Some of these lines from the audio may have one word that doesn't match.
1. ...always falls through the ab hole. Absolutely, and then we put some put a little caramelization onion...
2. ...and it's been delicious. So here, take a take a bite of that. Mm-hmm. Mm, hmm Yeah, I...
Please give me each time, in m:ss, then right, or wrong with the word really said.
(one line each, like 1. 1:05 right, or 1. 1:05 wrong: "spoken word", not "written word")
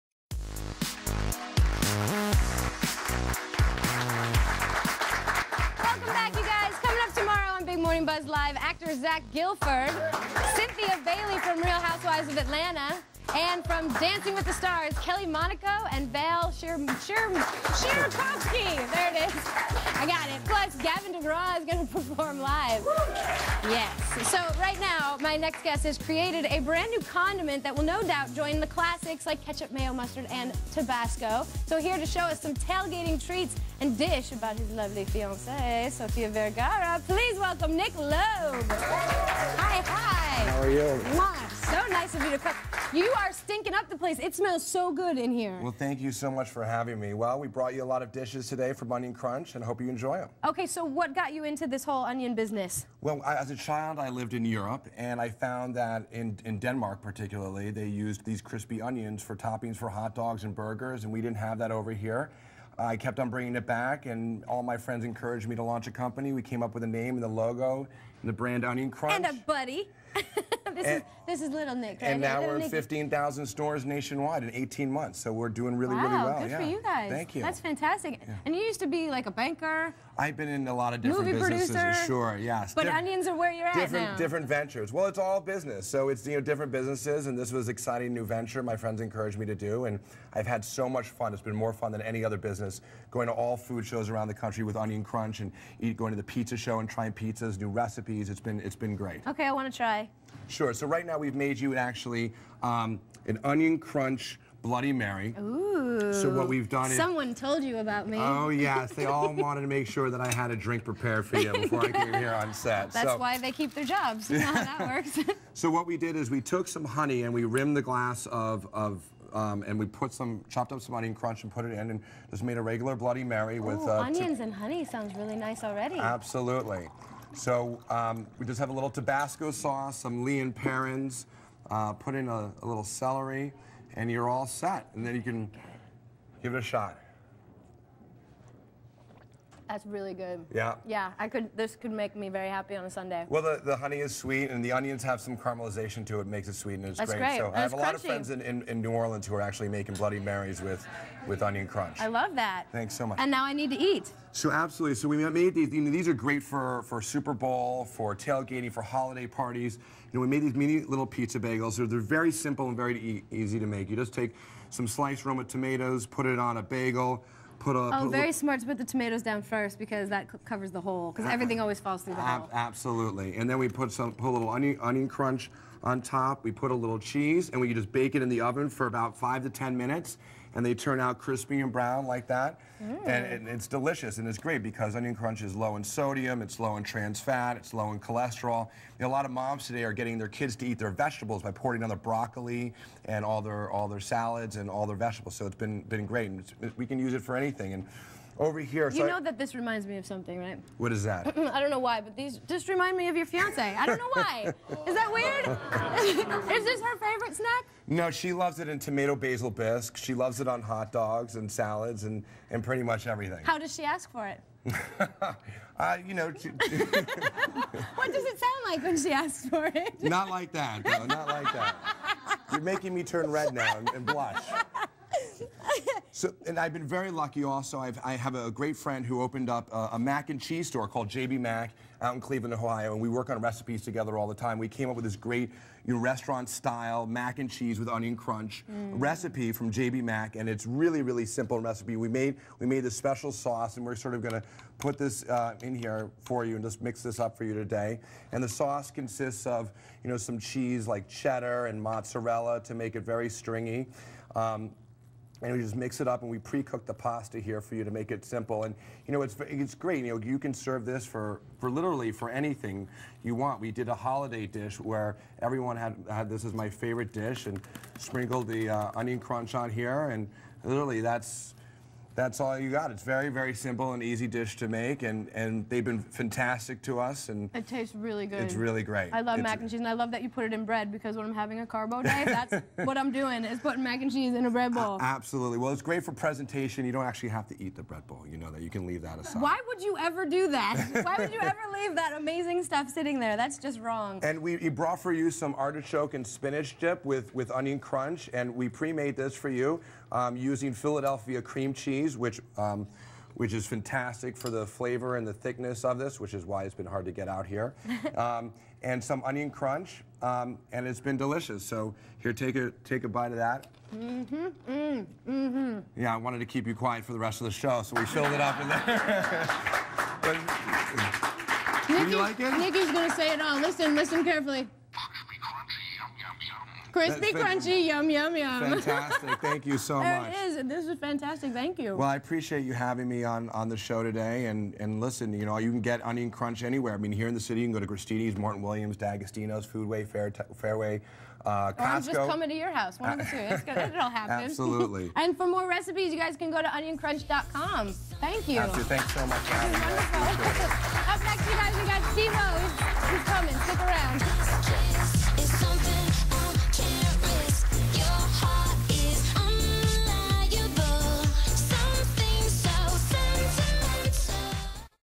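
1. 2:51 wrong: "onion", not "caramelization"
2. 5:10 right.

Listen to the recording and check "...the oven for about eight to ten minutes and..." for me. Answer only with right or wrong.
wrong.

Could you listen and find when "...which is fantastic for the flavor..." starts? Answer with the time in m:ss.
5:03.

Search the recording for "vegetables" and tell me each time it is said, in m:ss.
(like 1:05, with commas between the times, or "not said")
3:10, 3:14.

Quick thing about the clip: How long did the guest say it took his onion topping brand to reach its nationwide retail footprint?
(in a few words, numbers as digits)
18 months.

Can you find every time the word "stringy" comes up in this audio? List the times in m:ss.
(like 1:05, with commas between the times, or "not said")
4:13.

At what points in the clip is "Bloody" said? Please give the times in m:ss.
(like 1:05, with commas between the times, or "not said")
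1:44, 2:02, 2:29.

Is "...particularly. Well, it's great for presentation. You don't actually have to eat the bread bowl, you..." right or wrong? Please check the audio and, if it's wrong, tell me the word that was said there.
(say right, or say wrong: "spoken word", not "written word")
wrong: "absolutely", not "particularly".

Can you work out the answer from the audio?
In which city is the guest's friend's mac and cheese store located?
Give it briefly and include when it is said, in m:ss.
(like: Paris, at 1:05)
Cleveland, Ohio, at 3:52.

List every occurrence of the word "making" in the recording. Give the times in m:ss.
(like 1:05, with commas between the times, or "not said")
2:29, 3:42.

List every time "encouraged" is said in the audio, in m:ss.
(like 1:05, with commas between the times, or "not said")
1:05, 1:28.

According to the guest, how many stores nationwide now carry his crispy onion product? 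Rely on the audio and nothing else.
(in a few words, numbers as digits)
15,000.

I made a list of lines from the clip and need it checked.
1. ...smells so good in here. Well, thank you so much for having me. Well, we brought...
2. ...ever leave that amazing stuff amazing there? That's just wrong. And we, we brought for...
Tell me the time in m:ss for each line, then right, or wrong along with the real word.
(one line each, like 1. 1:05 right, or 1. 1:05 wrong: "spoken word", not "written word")
1. 0:44 right
2. 4:51 wrong: "sitting", not "amazing".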